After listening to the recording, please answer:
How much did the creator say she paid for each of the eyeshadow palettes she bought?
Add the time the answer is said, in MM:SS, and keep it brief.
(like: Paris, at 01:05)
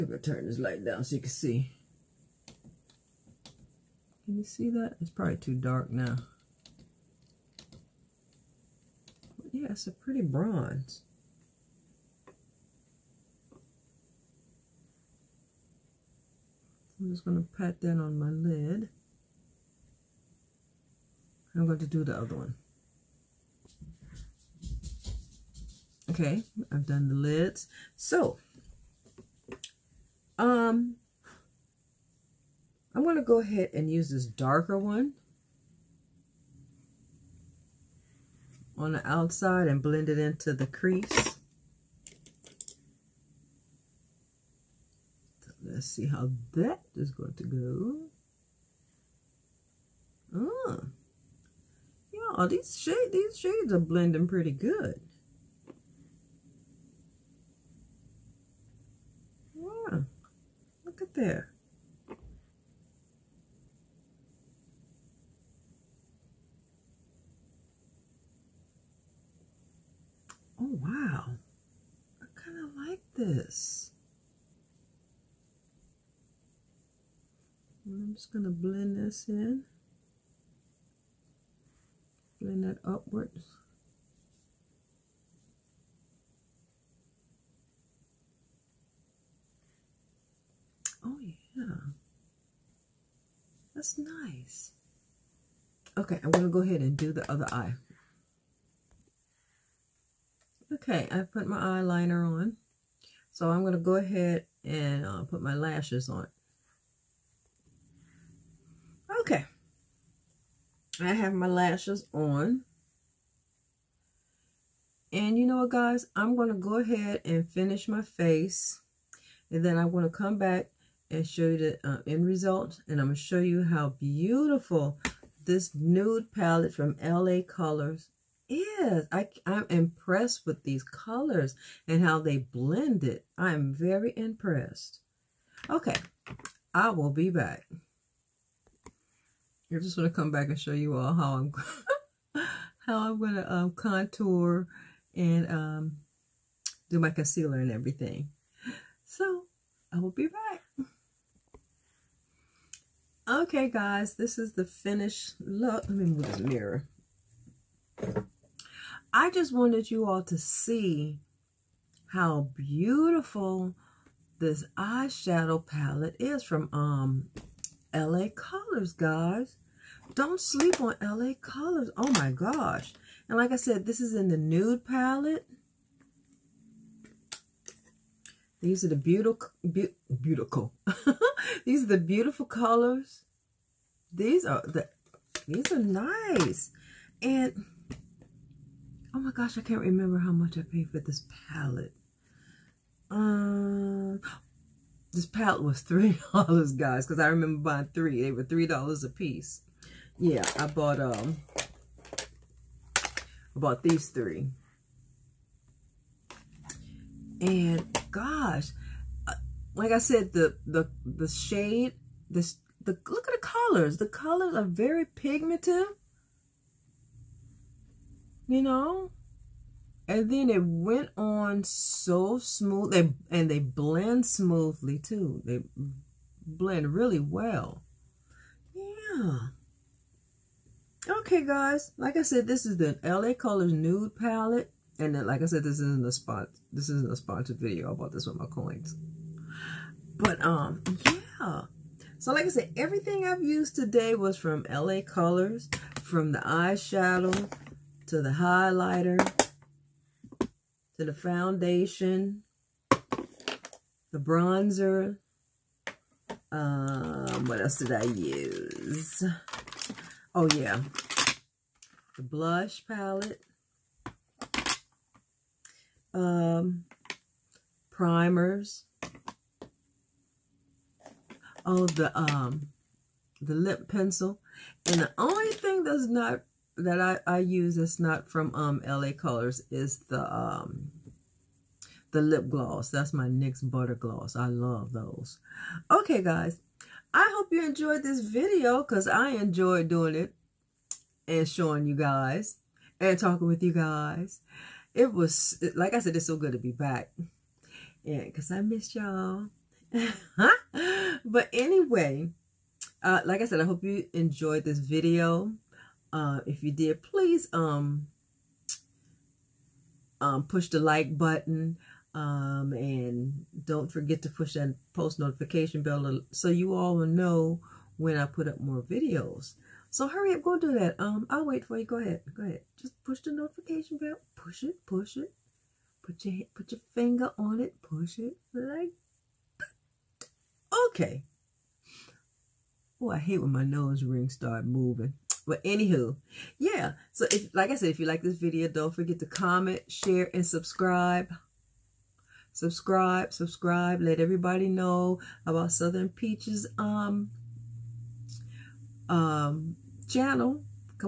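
$3, at 03:15.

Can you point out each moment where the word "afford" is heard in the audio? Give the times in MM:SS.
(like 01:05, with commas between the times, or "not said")
not said.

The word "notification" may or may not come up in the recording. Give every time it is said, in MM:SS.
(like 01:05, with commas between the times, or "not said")
05:15, 05:23.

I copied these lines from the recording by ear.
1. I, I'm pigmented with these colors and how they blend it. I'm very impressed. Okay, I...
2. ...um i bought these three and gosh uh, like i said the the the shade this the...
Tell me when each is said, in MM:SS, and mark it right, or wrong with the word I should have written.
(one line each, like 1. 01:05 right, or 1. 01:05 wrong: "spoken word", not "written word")
1. 02:09 wrong: "impressed", not "pigmented"
2. 03:21 right.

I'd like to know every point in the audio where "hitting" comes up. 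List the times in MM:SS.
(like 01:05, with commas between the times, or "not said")
not said.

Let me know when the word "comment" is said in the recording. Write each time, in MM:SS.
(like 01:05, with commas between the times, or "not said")
05:39.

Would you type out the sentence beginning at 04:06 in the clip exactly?
From the eyeshadow to the highlighter to the foundation, the bronzer.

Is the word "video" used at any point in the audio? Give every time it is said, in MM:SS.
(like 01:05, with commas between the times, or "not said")
03:57, 04:48, 05:04, 05:18, 05:38.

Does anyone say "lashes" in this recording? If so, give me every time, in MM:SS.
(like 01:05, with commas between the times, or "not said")
01:45, 01:51.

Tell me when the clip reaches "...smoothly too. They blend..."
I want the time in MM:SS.
03:44.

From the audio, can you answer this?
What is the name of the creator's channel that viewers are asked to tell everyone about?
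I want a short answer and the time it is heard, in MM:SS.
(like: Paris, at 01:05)
Southern Peaches, at 05:45.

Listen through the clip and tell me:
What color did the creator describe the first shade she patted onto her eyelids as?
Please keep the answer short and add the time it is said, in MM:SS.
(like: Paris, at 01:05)
bronze, at 00:10.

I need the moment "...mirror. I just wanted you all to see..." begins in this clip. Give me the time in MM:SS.
02:36.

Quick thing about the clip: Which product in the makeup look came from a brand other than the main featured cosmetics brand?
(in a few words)
NYX Butter Gloss.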